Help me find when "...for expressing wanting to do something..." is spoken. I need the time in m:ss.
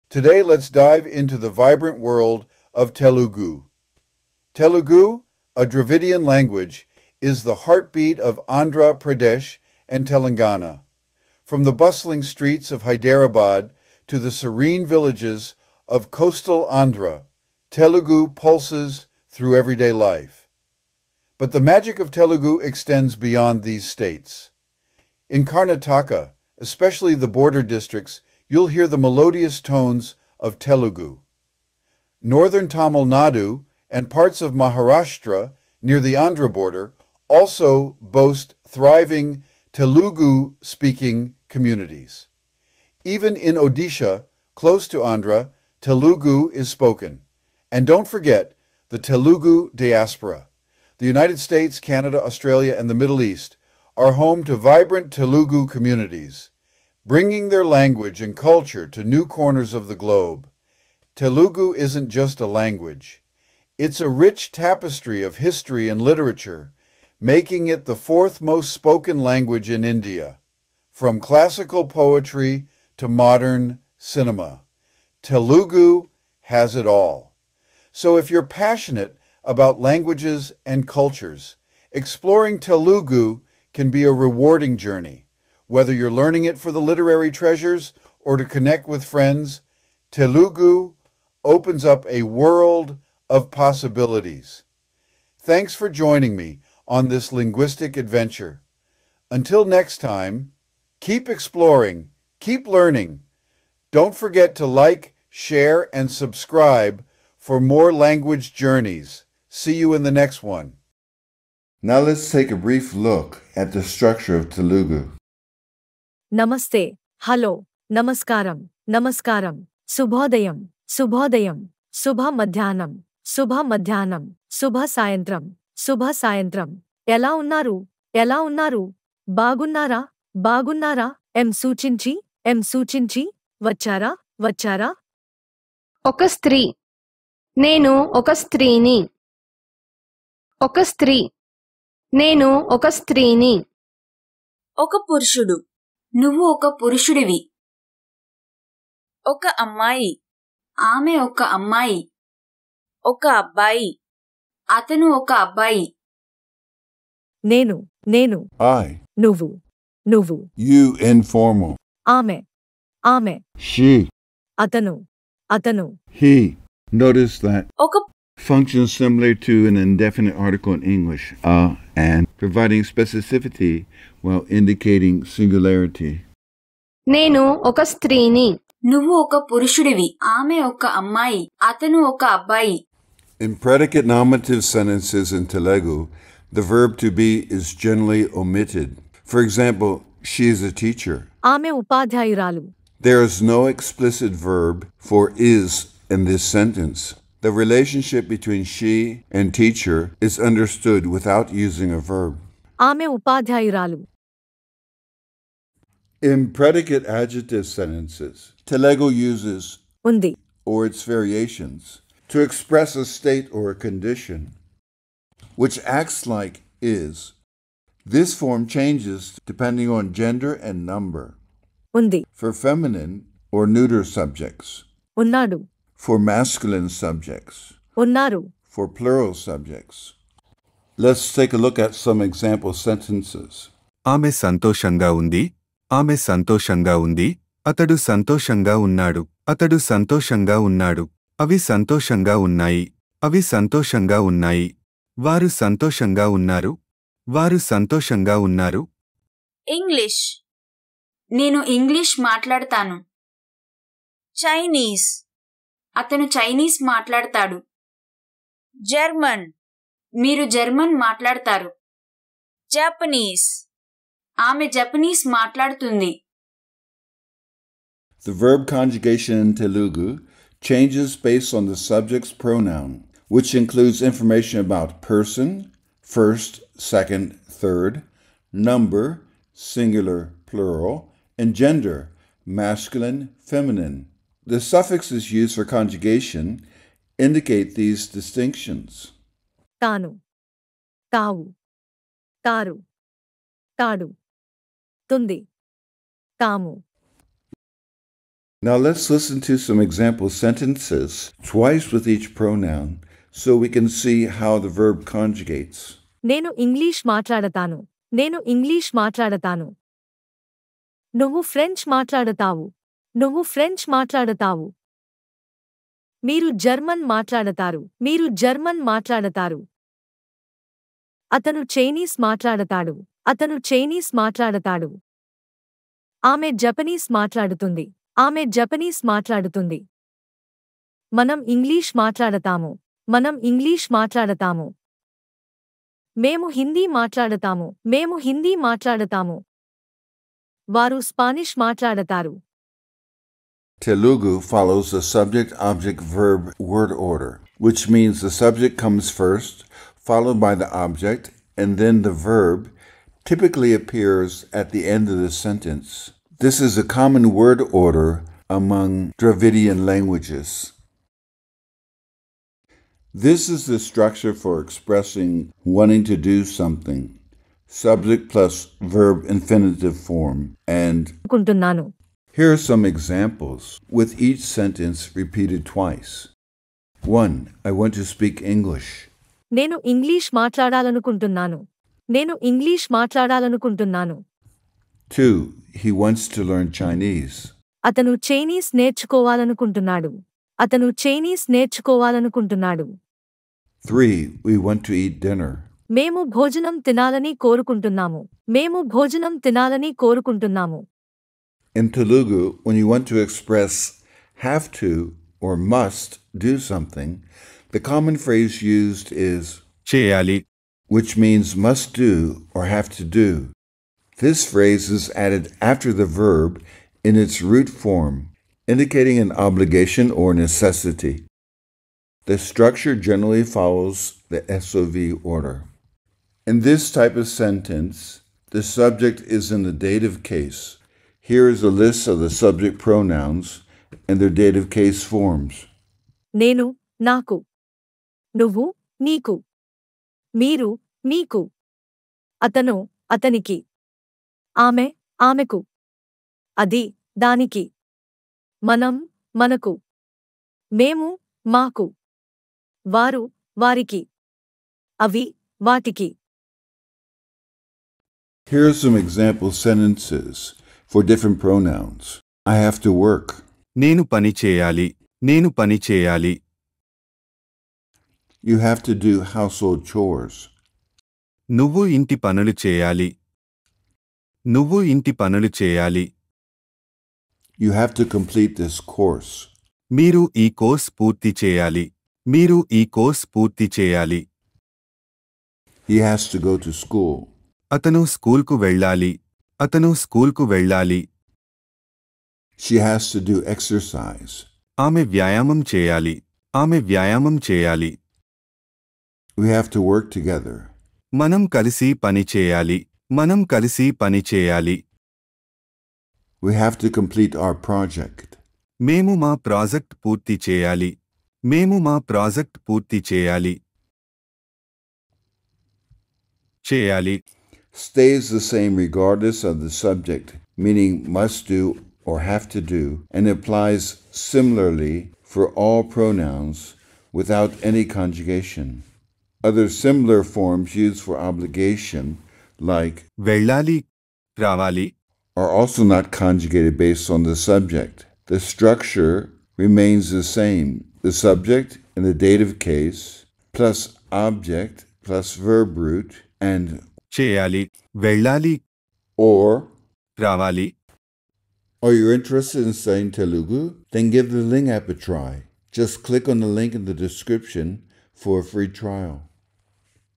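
6:04.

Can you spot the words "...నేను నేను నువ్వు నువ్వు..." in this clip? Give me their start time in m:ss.
2:37.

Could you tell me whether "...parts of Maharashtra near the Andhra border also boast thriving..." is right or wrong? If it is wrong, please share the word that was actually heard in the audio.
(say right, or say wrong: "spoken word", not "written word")
right.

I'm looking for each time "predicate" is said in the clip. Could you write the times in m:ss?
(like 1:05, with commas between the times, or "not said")
3:03, 3:26.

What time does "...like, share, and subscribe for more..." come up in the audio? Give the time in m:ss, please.
1:44.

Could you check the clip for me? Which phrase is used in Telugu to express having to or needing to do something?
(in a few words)
cheyali.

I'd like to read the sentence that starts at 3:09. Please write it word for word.
For example, she is a teacher.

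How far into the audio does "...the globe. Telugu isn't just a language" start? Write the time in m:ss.
0:59.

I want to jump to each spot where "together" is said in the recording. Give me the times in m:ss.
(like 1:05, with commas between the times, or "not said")
8:20.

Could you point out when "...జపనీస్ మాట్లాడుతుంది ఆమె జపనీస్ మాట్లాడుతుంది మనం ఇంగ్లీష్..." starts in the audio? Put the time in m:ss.
5:26.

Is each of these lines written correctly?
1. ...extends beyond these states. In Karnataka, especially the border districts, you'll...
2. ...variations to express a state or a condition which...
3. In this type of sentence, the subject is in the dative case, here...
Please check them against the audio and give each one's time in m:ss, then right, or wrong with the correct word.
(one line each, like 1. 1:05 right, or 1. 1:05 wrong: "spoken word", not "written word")
1. 0:22 right
2. 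3:31 right
3. 7:06 right.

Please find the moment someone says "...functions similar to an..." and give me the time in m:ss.
2:48.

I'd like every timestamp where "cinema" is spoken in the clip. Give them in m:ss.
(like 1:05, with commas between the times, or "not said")
1:13.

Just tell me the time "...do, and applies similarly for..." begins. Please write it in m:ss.
8:42.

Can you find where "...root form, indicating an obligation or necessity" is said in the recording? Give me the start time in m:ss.
6:57.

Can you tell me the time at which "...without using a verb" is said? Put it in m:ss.
3:21.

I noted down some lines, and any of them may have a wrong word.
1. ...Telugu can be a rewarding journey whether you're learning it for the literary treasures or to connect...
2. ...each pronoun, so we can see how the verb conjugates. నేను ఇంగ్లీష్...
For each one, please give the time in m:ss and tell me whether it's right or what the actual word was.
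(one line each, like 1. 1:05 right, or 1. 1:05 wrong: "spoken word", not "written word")
1. 1:22 right
2. 5:02 right.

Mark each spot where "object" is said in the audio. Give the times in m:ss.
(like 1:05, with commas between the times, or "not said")
5:45, 5:50, 9:04.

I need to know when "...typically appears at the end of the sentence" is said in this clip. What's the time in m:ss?
5:53.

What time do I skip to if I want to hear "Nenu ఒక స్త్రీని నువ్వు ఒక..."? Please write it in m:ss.
2:57.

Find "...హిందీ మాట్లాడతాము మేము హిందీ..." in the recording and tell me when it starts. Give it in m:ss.
5:36.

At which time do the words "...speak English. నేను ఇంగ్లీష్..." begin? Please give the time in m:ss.
6:18.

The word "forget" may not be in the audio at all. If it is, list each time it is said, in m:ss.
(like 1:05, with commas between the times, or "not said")
0:48, 1:44.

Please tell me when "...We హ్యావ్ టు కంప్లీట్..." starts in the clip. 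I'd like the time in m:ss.
8:26.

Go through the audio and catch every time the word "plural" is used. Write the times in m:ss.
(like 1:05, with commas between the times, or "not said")
3:48, 4:40.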